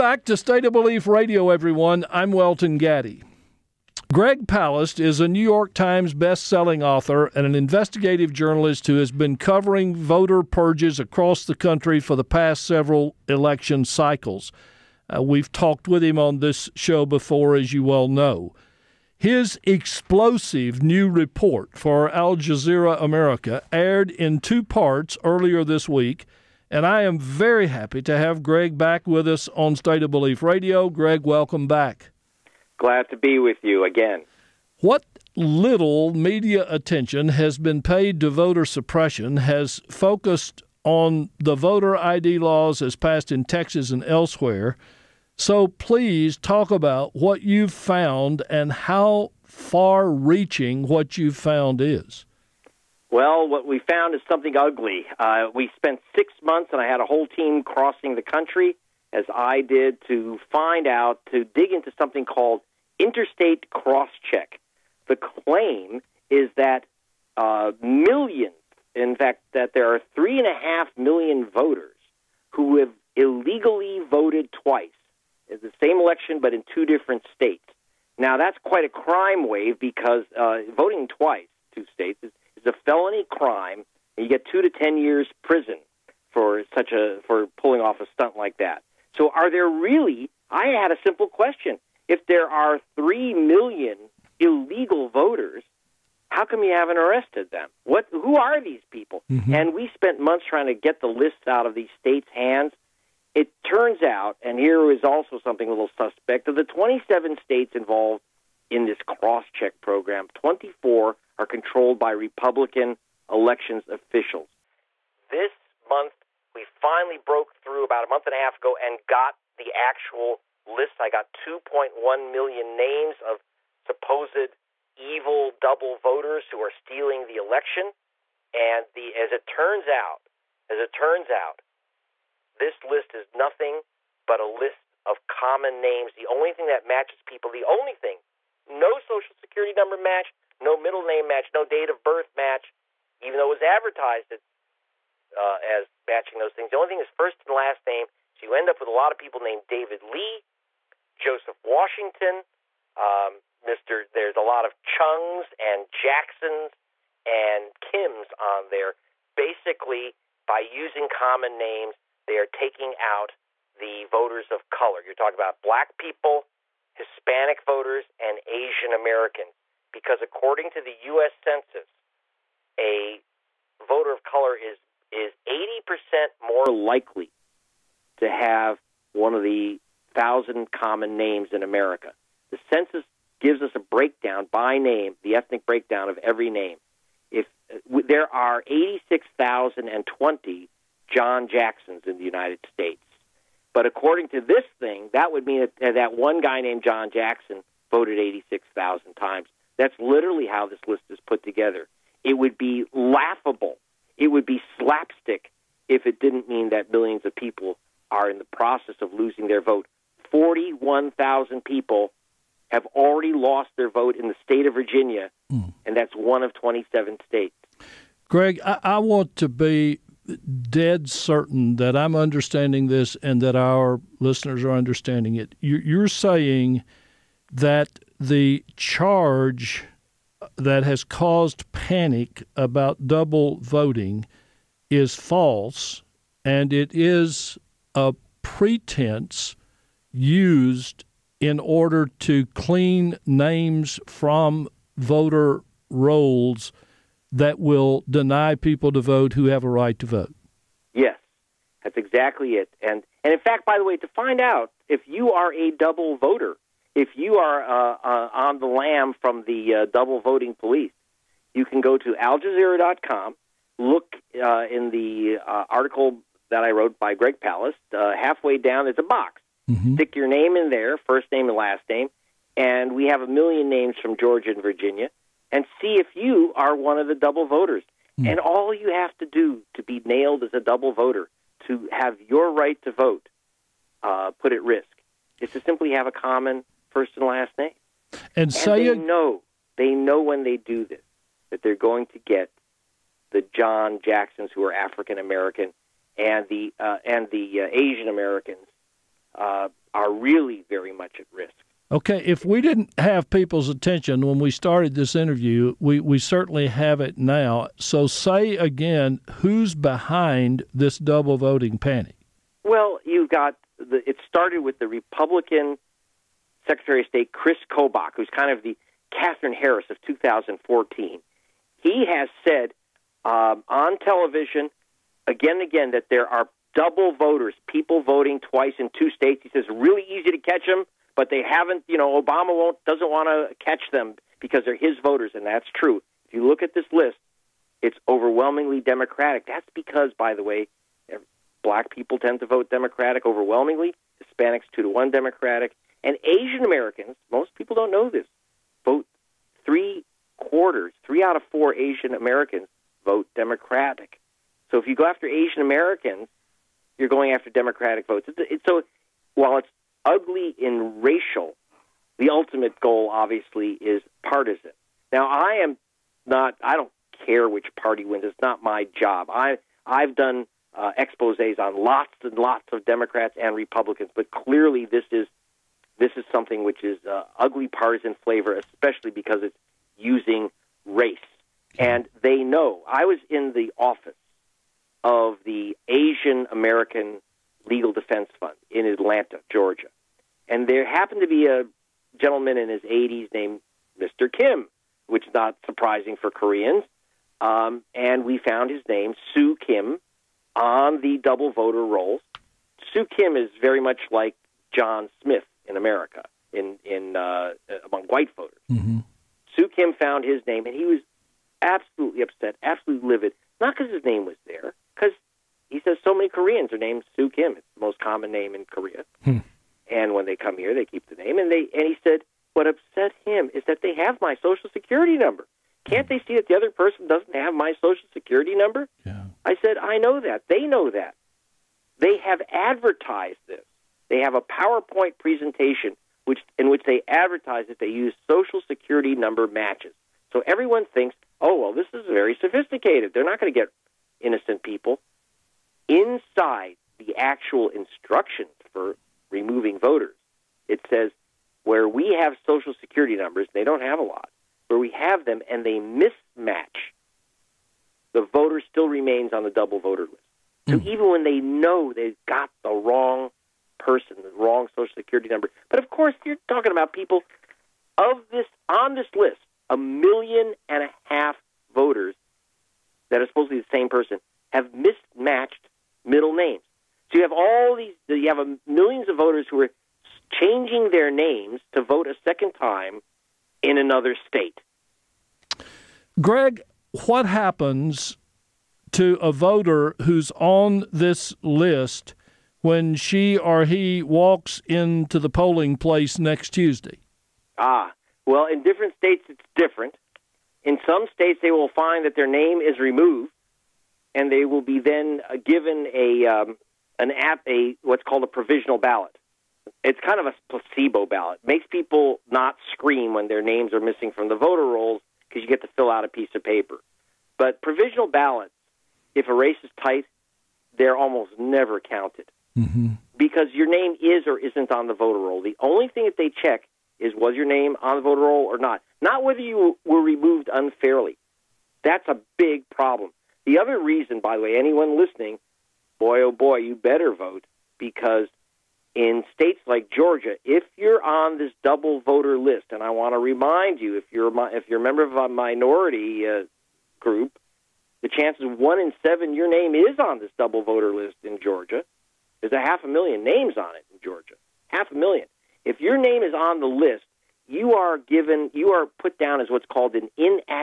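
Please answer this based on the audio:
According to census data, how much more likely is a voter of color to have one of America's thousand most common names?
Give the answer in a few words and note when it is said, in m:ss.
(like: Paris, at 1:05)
80%, at 2:55.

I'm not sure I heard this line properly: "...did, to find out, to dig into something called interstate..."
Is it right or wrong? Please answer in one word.
right.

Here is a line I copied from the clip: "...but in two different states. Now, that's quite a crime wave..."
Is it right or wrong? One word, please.
right.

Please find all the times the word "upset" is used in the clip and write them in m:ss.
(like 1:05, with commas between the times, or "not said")
6:52, 7:02.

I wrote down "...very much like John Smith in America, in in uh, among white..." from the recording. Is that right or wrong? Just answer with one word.
right.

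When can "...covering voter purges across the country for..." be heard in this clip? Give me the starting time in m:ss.
0:09.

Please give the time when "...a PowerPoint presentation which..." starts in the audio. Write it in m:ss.
7:14.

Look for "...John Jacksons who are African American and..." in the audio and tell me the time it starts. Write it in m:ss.
4:53.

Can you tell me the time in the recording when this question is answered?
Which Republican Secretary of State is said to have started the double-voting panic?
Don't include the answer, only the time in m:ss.
5:17.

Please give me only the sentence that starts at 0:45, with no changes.
So please talk about what you've found and how far reaching what you've found is.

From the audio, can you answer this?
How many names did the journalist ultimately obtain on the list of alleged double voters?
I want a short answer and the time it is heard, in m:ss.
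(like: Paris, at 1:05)
2.1 million, at 2:01.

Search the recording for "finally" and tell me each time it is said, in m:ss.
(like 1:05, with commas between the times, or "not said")
1:56.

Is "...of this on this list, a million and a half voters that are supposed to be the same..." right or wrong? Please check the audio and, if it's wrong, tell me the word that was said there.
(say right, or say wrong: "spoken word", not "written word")
right.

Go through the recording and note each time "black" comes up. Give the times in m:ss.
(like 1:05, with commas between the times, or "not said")
2:45, 5:41.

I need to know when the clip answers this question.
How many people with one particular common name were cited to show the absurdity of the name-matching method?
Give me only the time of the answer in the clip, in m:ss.
3:08.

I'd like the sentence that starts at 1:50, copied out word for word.
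24 are controlled by Republican elections officials.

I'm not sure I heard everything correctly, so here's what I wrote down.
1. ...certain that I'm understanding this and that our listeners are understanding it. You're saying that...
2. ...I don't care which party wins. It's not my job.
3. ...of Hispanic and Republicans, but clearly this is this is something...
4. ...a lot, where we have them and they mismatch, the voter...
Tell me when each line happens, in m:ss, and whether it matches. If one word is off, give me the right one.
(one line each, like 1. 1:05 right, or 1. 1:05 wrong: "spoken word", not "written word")
1. 3:41 right
2. 6:06 right
3. 6:12 wrong: "Democrats", not "Hispanic"
4. 7:33 right.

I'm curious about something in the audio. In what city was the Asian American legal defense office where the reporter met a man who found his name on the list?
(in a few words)
Atlanta.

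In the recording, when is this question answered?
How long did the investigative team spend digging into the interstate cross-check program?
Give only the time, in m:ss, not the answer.
0:56.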